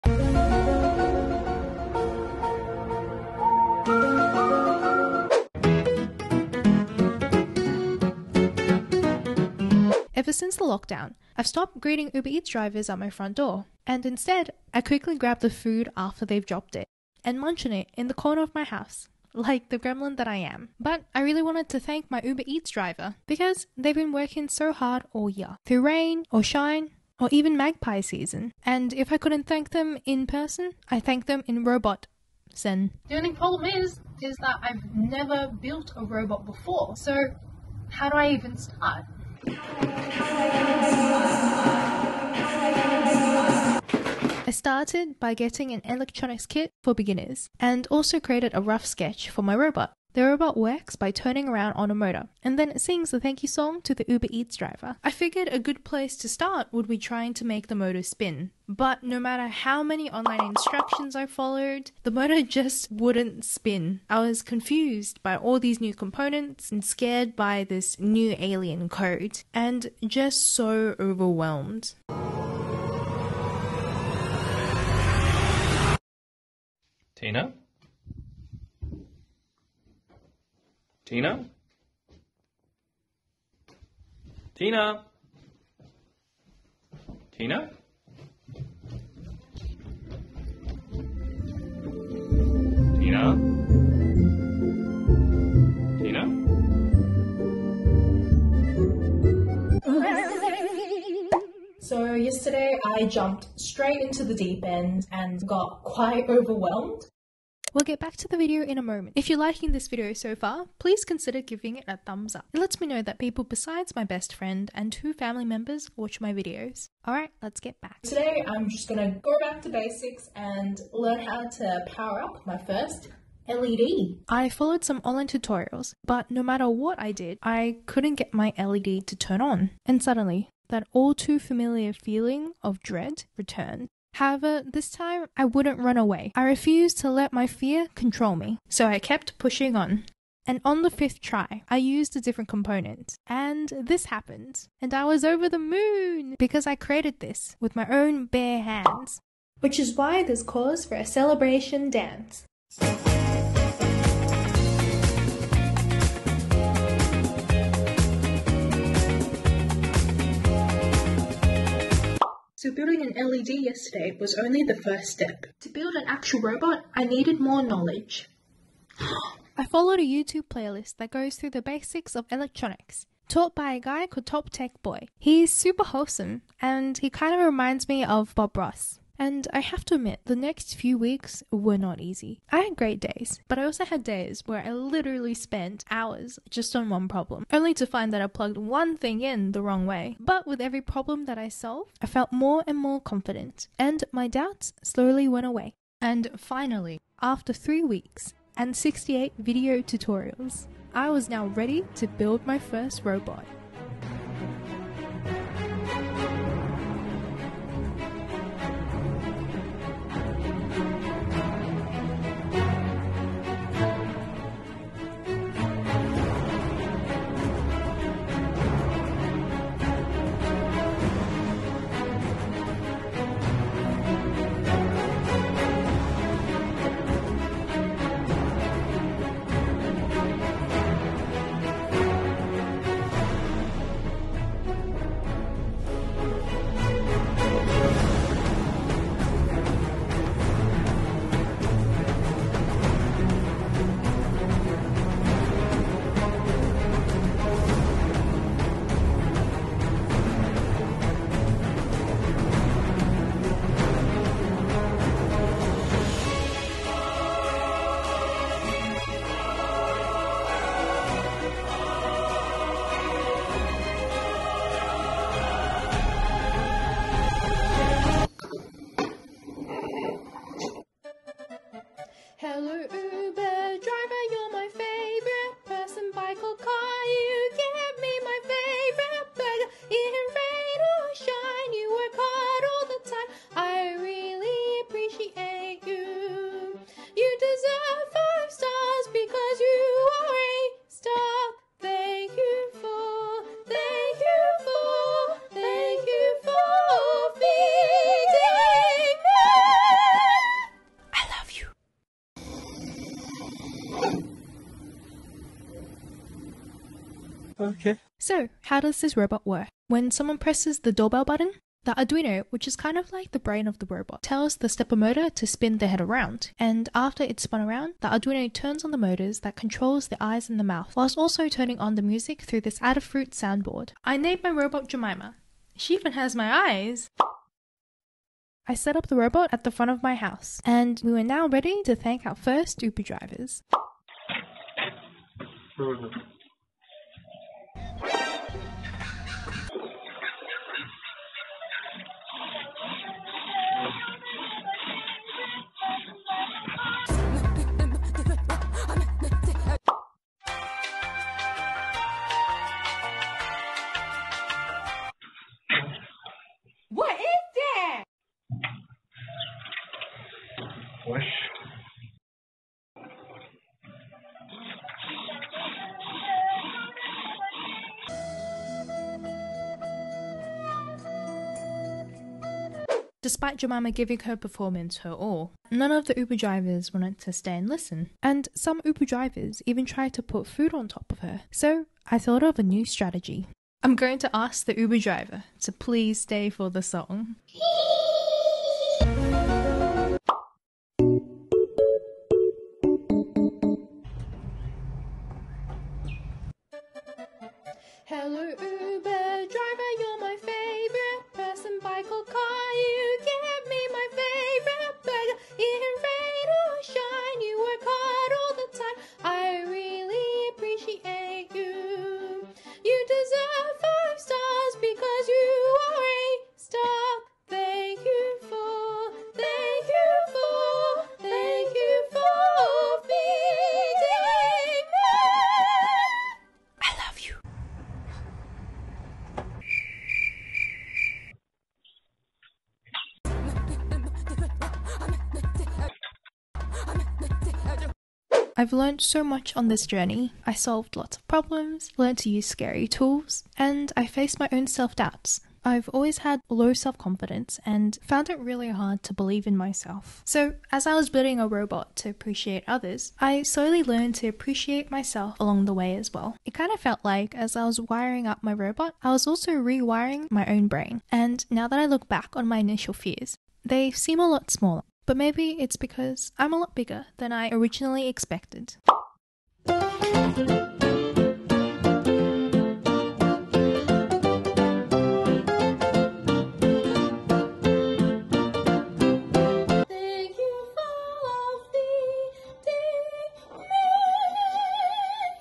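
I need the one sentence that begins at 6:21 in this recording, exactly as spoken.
So I thought of a new strategy.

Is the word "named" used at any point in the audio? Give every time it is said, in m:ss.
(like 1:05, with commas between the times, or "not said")
5:24.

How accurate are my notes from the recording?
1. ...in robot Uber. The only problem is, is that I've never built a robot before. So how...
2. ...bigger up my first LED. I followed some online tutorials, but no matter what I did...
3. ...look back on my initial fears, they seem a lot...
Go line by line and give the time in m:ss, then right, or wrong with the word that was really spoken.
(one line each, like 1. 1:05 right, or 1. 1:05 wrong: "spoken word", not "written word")
1. 0:31 wrong: "Sen", not "Uber"
2. 2:01 wrong: "power", not "bigger"
3. 7:41 right.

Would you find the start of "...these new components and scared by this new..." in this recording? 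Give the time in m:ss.
1:05.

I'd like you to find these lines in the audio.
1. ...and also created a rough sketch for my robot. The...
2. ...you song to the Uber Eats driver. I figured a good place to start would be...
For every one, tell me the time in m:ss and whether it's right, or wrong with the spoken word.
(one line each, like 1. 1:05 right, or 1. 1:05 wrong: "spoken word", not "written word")
1. 0:47 right
2. 0:53 right.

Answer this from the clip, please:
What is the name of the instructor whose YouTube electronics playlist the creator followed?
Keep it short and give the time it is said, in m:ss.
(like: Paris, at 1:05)
Top Tech Boy, at 2:54.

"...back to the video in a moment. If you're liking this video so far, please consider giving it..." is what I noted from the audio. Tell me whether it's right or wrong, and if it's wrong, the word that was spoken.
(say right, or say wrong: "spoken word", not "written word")
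right.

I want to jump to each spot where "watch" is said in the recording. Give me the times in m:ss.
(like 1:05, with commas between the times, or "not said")
1:55.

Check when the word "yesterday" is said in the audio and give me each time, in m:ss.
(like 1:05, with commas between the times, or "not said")
1:42, 2:43.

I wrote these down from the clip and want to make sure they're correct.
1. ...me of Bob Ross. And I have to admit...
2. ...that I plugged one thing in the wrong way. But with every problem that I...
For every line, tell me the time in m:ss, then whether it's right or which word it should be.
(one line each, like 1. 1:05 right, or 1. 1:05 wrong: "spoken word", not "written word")
1. 2:57 right
2. 3:08 right.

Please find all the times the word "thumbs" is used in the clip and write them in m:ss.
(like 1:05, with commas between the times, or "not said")
1:51.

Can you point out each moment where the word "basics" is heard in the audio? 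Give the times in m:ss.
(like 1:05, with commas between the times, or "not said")
1:59, 2:51.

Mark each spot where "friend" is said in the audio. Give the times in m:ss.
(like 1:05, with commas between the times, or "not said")
1:54.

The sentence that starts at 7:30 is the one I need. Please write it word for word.
So, as I was building a robot to appreciate others, I slowly learned to appreciate myself along the way as well.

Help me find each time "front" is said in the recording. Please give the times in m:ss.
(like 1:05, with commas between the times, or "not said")
0:13, 5:29.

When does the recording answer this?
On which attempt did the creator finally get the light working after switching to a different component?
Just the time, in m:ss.
2:20.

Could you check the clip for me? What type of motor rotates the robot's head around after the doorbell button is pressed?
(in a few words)
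Stepper motor.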